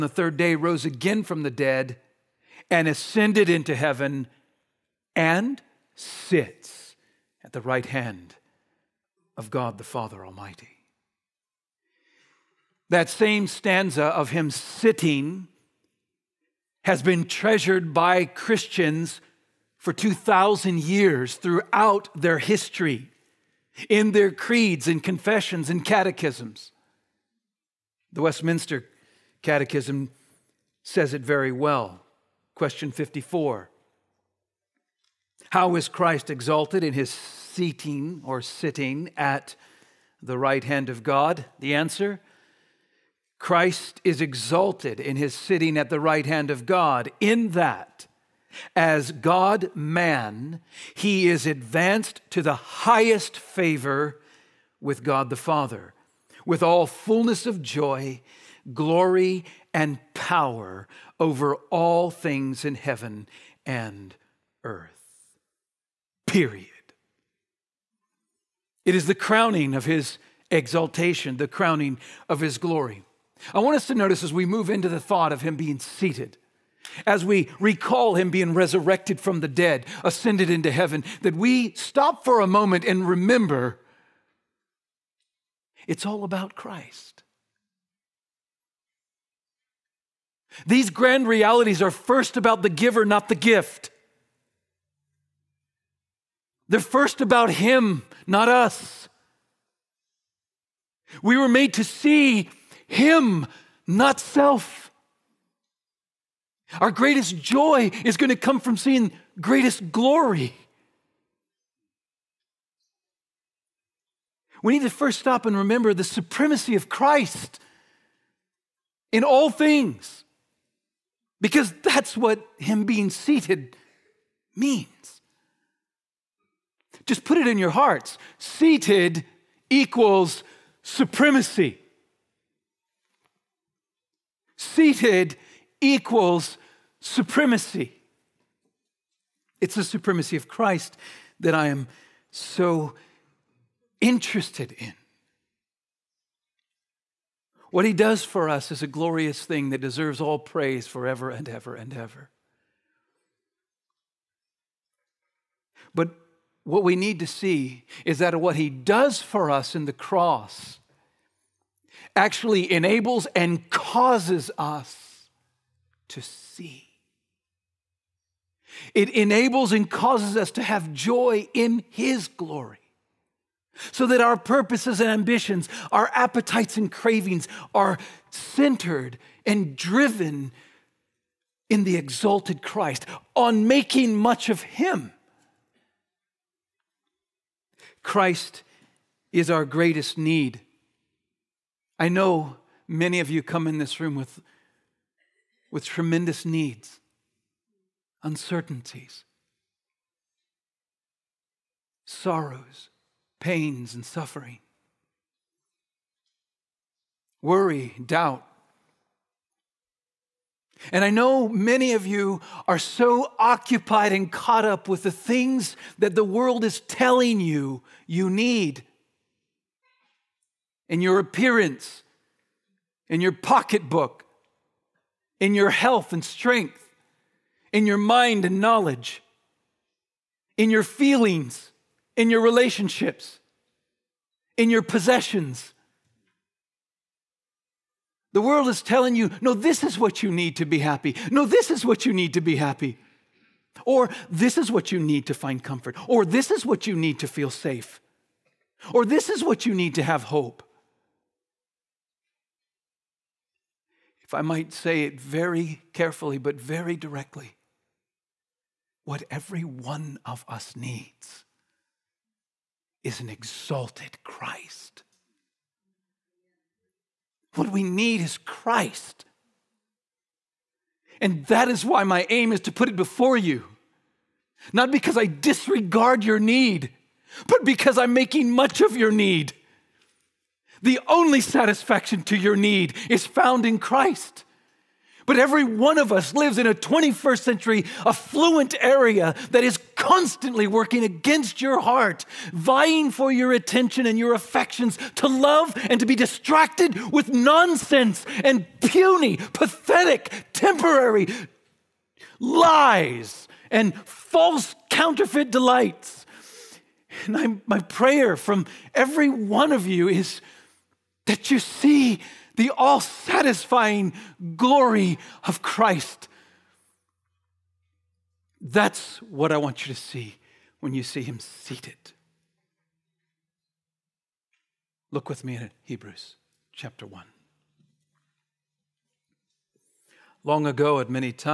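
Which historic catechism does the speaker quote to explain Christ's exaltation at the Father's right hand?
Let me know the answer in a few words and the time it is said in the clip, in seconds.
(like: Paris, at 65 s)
Westminster Catechism, at 28 s.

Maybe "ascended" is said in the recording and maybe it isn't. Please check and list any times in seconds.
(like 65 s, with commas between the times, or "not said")
2 s, 80 s.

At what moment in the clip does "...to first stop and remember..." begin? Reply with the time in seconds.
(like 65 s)
114 s.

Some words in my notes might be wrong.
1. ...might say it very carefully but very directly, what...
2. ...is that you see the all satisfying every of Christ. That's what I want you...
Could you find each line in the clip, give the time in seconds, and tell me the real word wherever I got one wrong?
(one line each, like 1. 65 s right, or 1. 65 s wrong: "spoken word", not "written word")
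1. 254 s right
2. 310 s wrong: "glory", not "every".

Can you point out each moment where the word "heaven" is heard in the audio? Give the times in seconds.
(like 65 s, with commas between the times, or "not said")
3 s, 62 s, 80 s.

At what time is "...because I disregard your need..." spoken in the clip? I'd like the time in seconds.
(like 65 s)
274 s.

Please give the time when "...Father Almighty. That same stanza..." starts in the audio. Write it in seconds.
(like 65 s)
9 s.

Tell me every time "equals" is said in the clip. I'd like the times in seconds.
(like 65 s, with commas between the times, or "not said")
129 s, 135 s.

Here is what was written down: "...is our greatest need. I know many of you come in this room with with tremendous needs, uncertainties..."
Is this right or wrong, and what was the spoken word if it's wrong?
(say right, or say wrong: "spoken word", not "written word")
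right.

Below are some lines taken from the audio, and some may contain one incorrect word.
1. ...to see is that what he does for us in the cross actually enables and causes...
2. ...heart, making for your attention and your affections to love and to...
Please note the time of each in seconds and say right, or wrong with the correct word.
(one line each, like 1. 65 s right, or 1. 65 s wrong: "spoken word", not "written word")
1. 157 s right
2. 291 s wrong: "vying", not "making".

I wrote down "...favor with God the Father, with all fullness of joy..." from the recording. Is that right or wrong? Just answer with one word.
right.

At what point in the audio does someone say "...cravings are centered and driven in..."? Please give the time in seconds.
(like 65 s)
176 s.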